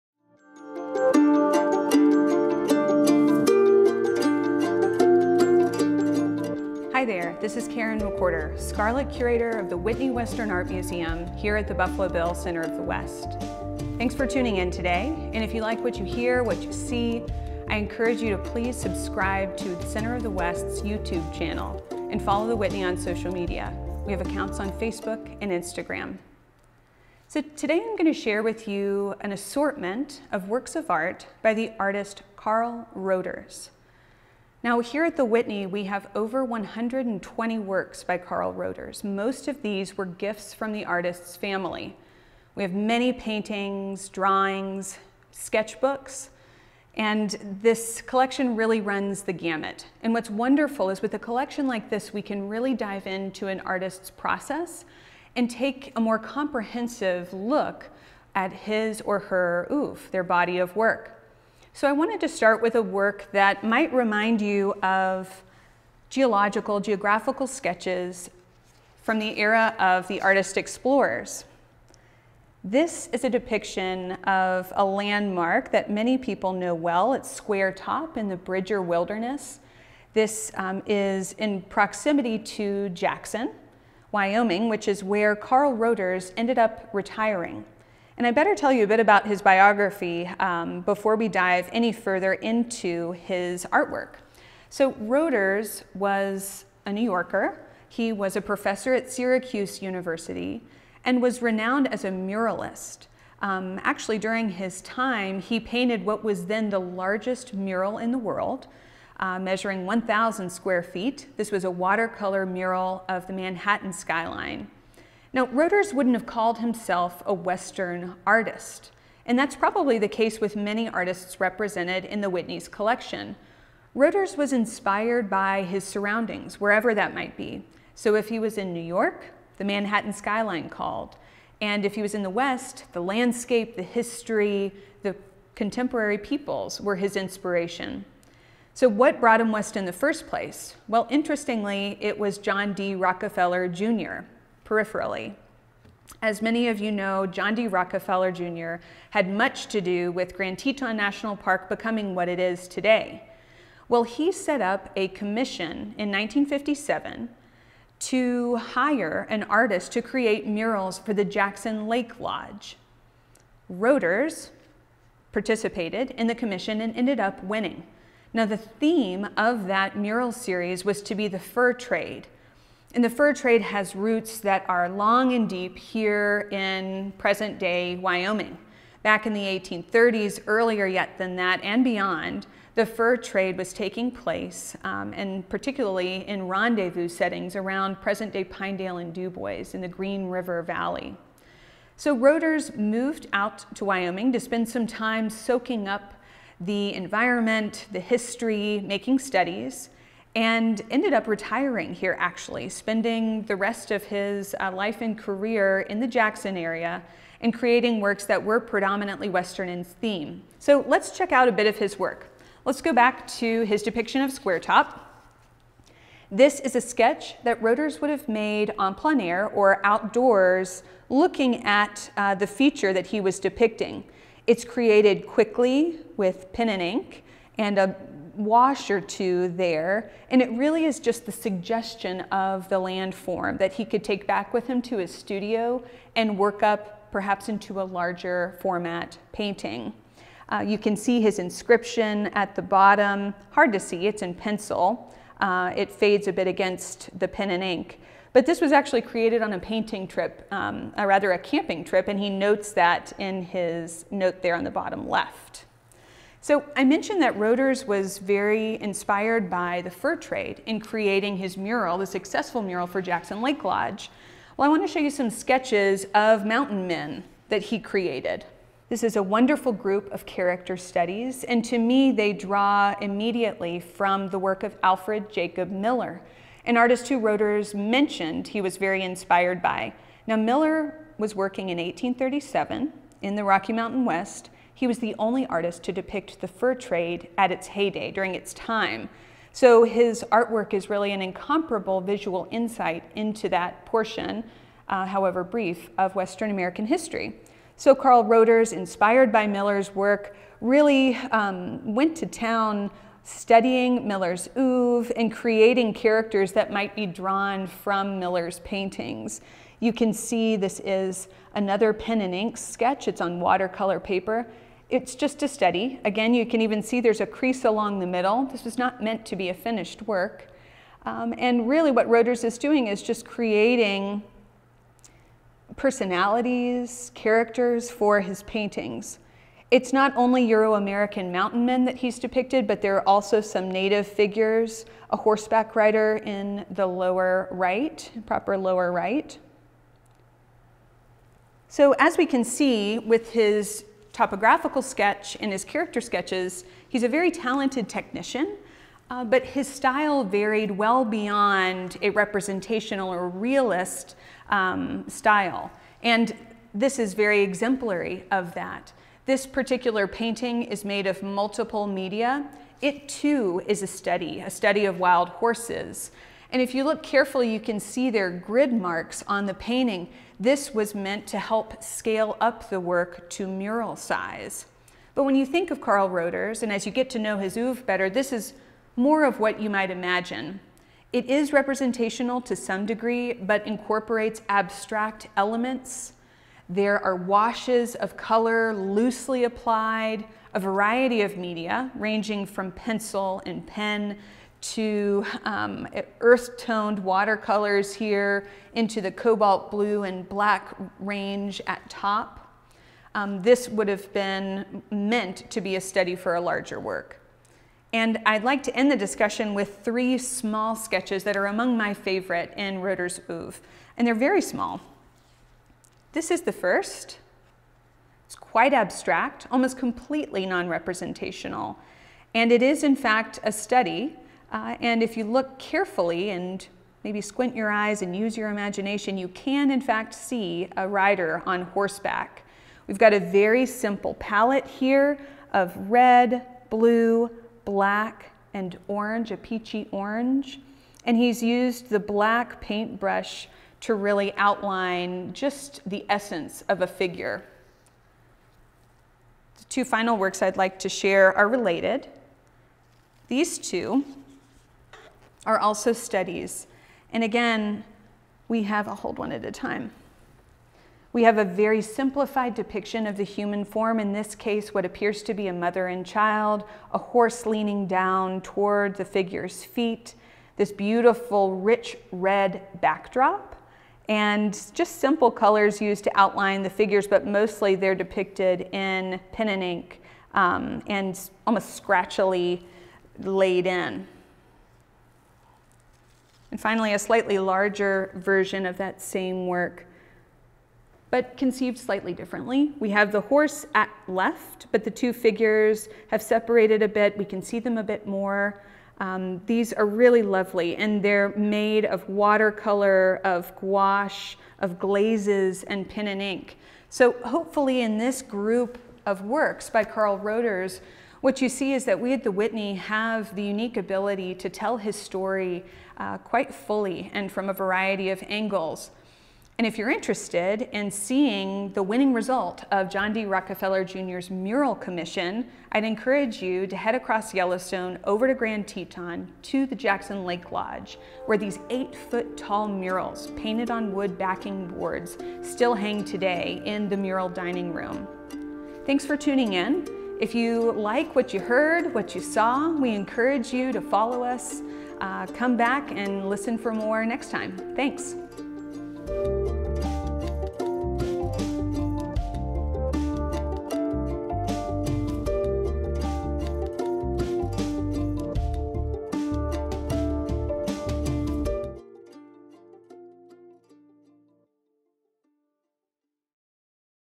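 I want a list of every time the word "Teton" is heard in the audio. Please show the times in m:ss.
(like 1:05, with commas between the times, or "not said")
2:30, 8:48.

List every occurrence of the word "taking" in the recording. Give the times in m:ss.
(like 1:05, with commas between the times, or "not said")
3:03.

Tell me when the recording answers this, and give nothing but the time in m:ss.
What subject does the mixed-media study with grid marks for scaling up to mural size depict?
6:04.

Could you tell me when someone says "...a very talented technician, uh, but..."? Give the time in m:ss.
5:47.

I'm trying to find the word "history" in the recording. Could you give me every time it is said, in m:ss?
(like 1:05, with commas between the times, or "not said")
2:13, 3:17, 4:56.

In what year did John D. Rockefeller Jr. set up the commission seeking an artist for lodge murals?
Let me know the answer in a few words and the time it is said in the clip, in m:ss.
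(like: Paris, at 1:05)
1957, at 2:36.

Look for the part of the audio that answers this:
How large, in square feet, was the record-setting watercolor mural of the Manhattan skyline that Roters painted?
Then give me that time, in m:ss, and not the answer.
1:49.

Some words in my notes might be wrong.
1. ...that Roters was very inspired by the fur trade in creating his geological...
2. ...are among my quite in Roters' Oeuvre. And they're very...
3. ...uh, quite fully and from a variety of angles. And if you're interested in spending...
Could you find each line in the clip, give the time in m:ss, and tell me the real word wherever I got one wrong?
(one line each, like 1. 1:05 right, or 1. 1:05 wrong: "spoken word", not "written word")
1. 4:17 wrong: "mural", not "geological"
2. 6:51 wrong: "favorite", not "quite"
3. 8:35 wrong: "seeing", not "spending".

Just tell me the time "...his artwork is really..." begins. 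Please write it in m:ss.
4:49.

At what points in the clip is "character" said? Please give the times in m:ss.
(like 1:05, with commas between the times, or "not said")
4:30, 5:05, 5:27, 5:45.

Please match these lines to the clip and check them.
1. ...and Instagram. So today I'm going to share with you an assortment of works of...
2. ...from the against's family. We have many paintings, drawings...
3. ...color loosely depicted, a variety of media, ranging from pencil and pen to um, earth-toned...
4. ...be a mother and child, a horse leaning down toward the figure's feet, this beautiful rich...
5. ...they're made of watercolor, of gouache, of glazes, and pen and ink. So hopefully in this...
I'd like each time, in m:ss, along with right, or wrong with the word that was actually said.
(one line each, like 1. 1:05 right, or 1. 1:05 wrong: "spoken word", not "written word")
1. 0:25 right
2. 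0:40 wrong: "artist", not "against"
3. 6:28 wrong: "applied", not "depicted"
4. 7:45 right
5. 8:21 right.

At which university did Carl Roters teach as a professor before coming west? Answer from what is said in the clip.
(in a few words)
Syracuse University.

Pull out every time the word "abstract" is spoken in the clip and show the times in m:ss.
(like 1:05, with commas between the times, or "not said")
6:24, 6:58.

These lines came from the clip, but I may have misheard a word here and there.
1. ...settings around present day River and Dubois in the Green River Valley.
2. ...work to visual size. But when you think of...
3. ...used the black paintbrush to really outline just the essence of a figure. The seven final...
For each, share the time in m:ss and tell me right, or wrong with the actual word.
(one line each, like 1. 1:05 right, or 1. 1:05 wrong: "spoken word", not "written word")
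1. 3:07 wrong: "Pinedale", not "River"
2. 6:12 wrong: "mural", not "visual"
3. 7:21 wrong: "two", not "seven".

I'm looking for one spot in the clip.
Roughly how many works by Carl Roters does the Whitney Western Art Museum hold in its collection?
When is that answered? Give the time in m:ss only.
0:36.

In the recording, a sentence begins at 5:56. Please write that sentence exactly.
And this is very exemplary of that.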